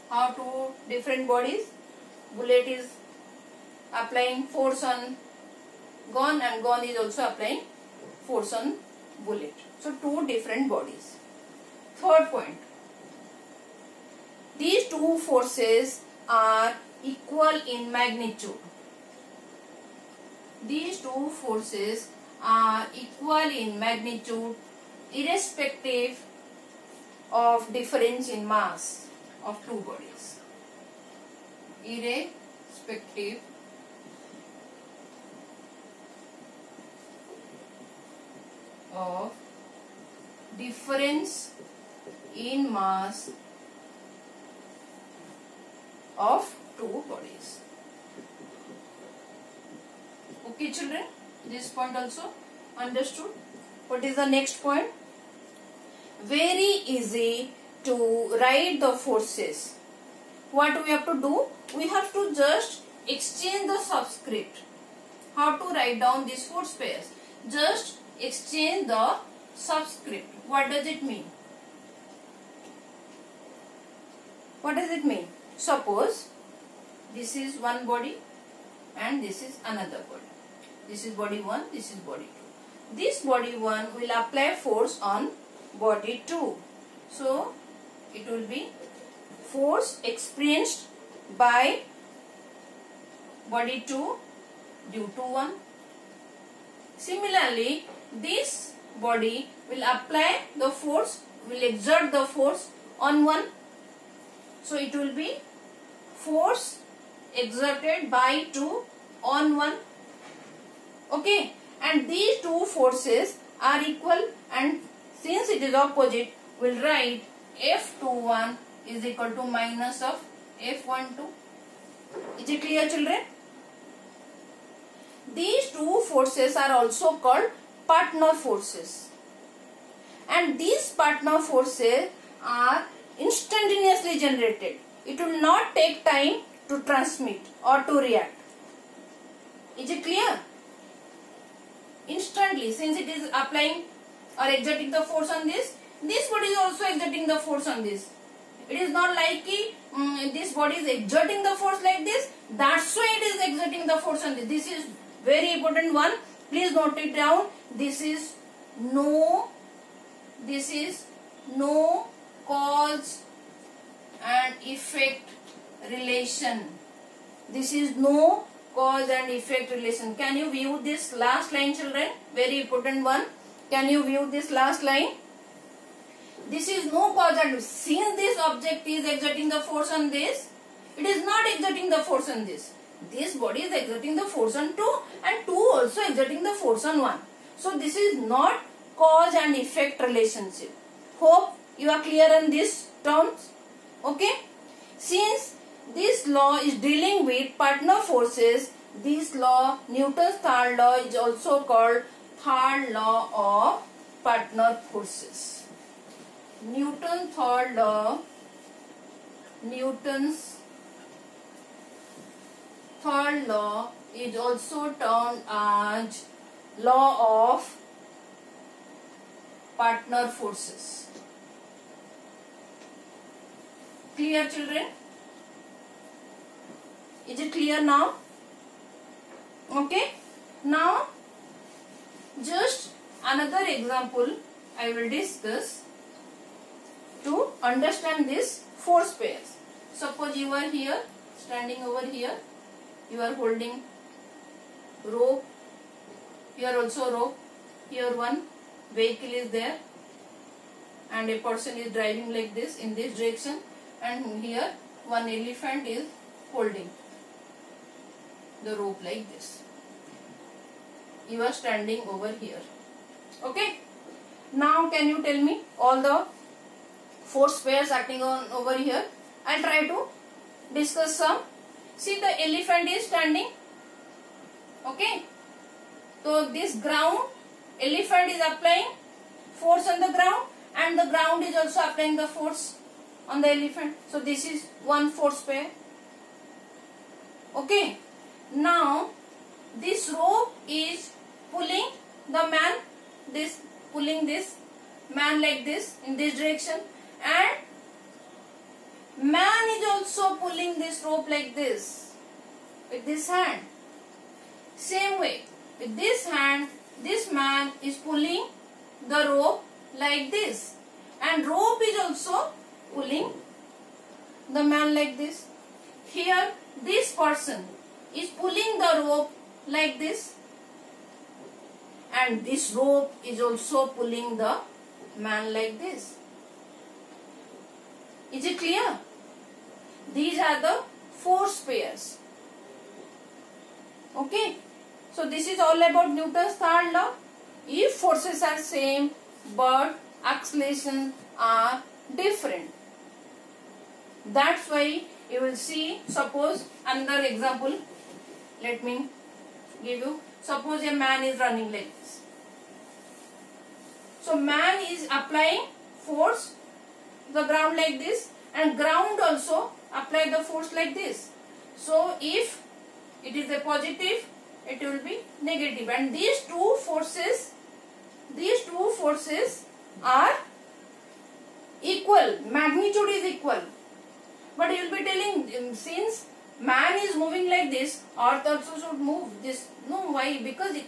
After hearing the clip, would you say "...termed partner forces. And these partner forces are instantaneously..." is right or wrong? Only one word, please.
wrong.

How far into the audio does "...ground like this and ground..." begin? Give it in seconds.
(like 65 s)
357 s.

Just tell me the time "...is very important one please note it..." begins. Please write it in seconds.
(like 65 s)
154 s.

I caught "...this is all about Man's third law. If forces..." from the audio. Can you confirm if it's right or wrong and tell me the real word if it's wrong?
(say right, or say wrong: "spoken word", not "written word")
wrong: "Newton", not "Man".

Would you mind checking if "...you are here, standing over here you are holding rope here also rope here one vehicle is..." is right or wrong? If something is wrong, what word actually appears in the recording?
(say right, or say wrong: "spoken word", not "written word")
right.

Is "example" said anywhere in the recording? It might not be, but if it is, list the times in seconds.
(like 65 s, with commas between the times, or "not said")
233 s, 347 s.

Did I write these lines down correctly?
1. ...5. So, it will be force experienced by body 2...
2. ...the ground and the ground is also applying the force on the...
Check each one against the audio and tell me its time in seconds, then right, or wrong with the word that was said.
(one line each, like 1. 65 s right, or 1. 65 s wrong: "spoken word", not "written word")
1. 86 s wrong: "2", not "5"
2. 280 s right.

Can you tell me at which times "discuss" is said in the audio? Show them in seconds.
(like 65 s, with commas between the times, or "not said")
235 s, 270 s.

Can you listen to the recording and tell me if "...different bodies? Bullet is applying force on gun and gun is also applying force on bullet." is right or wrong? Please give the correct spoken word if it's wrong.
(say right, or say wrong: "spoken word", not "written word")
right.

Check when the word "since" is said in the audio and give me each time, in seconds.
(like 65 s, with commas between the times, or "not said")
115 s, 142 s, 177 s, 194 s, 375 s.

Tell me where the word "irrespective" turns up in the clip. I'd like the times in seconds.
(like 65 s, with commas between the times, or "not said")
25 s, 31 s.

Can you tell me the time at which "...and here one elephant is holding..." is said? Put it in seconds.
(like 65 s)
254 s.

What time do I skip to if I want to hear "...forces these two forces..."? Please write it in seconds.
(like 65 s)
366 s.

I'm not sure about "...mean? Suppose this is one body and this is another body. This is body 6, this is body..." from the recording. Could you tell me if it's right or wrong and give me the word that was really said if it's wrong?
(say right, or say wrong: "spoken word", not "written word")
wrong: "1", not "6".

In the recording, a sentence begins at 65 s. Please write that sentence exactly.
How to write down these force pairs?